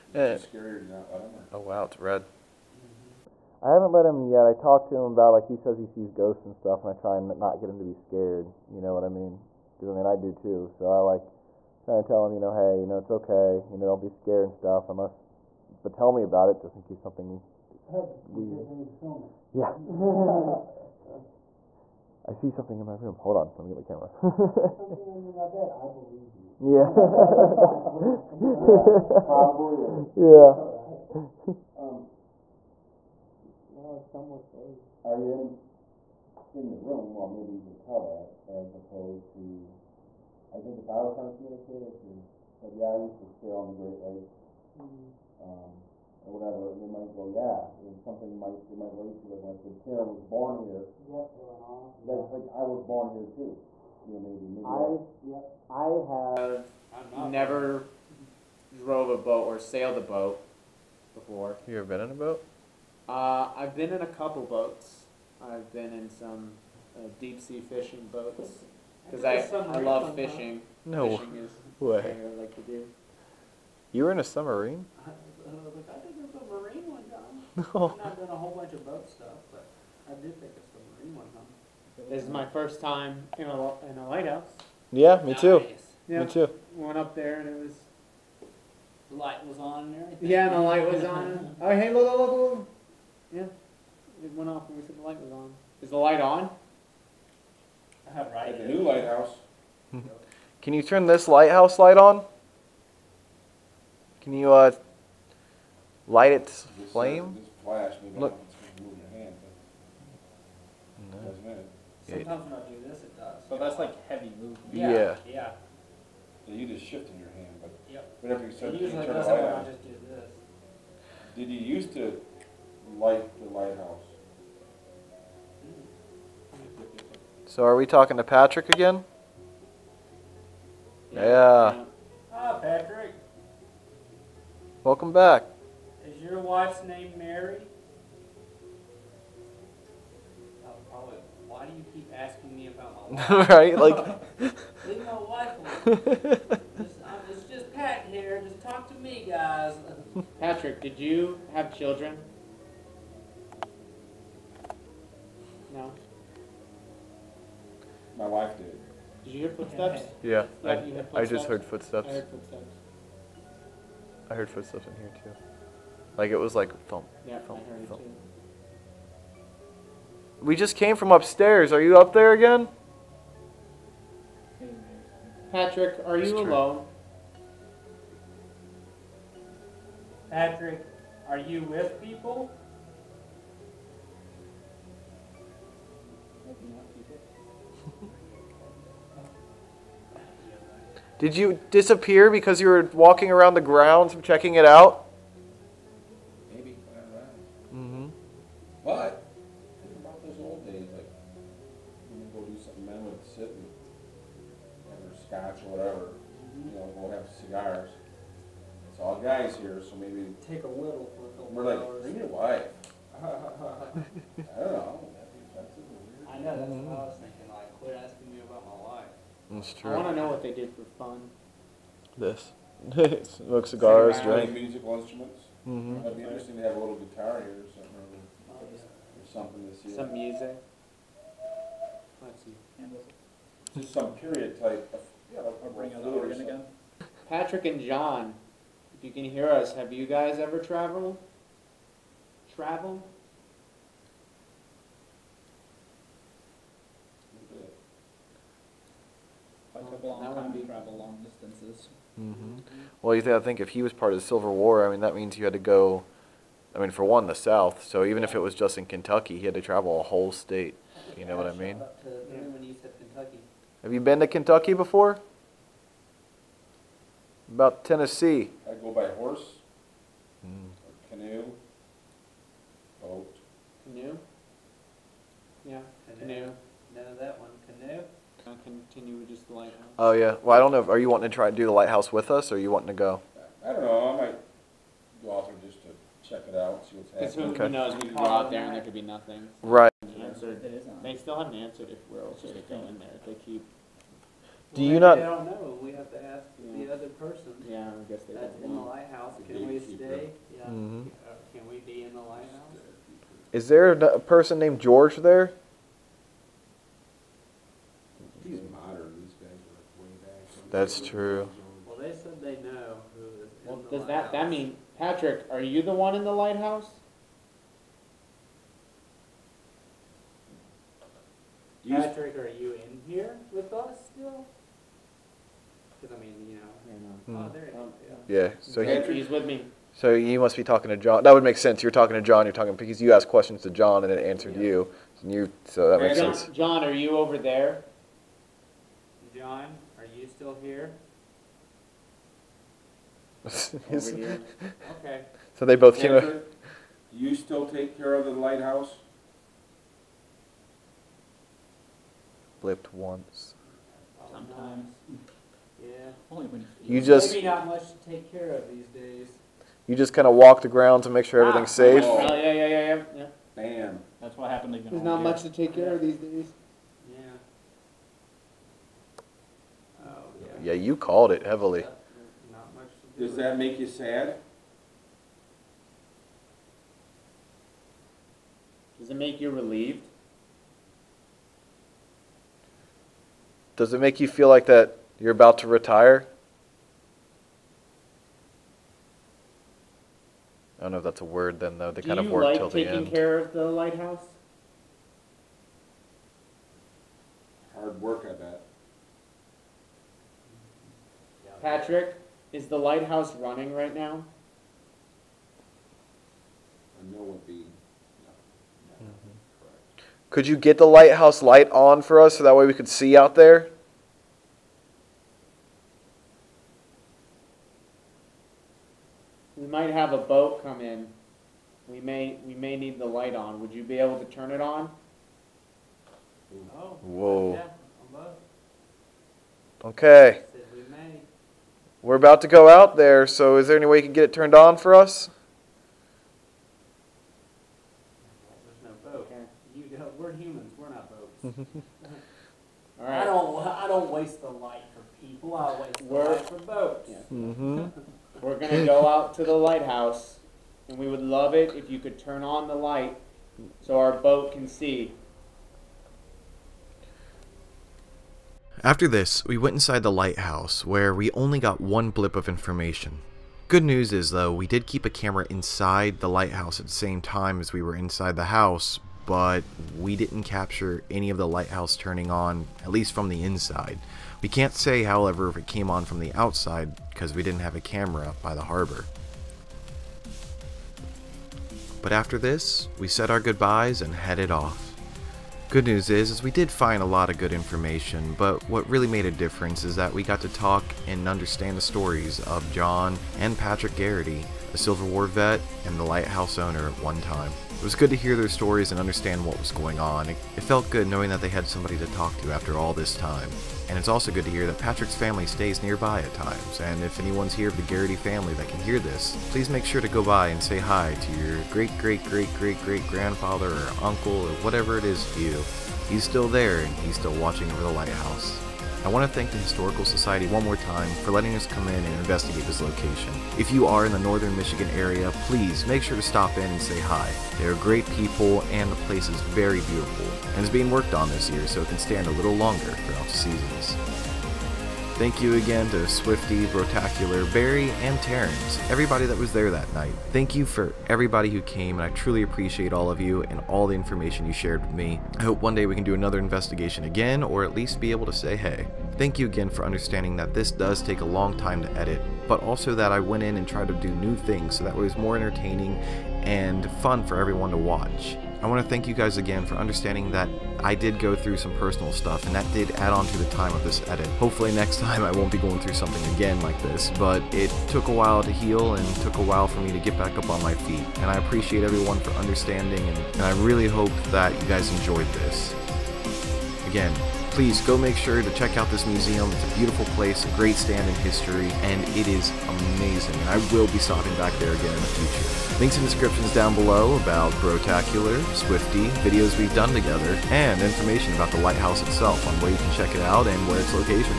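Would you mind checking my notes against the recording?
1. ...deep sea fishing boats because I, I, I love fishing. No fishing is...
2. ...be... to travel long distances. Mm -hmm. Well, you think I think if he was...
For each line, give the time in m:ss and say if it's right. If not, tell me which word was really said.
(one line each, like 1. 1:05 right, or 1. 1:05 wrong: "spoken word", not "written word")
1. 1:07 right
2. 4:10 right.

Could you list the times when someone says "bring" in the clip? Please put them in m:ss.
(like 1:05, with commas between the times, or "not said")
3:32, 3:55.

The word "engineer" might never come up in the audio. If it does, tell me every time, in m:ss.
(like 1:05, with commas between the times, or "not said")
not said.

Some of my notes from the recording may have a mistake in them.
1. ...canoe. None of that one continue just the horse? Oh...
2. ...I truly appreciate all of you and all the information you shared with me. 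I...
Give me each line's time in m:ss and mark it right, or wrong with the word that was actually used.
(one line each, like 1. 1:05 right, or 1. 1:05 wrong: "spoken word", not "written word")
1. 4:36 wrong: "lighthouse", not "horse"
2. 9:02 right.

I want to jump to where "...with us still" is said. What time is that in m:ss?
5:23.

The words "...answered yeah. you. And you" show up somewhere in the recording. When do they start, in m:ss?
5:34.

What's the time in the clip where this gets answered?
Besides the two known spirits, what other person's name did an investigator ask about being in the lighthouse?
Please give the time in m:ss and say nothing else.
5:04.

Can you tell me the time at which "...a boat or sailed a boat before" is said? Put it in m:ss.
0:59.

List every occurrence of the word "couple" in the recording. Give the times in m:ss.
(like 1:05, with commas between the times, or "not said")
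1:04, 3:31.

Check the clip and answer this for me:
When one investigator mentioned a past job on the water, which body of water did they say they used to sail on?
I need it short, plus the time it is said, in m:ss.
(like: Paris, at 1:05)
Great Lakes, at 0:43.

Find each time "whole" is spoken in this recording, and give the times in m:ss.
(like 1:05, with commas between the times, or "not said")
1:18, 4:20.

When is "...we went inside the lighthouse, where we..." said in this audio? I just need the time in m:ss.
7:39.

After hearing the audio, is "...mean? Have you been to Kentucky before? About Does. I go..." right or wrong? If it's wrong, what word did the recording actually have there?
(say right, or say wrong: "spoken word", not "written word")
wrong: "Tennessee", not "Does".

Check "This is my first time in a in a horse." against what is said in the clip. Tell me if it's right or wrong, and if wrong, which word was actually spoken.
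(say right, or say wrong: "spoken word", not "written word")
wrong: "lighthouse", not "horse".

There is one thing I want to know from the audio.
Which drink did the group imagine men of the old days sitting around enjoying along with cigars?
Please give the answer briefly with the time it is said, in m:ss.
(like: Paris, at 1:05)
Scotch, at 3:25.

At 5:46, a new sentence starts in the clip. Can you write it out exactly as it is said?
Andrew, do you still take care of the lighthouse?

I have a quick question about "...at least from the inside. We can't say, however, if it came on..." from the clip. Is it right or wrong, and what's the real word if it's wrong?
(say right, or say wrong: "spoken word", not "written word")
right.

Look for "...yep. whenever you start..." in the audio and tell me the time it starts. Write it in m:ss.
1:57.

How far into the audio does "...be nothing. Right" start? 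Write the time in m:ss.
4:48.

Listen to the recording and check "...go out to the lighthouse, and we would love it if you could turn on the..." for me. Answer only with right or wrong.
right.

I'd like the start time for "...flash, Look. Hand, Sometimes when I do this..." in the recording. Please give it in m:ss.
1:47.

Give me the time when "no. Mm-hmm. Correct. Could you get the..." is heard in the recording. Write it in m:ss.
6:47.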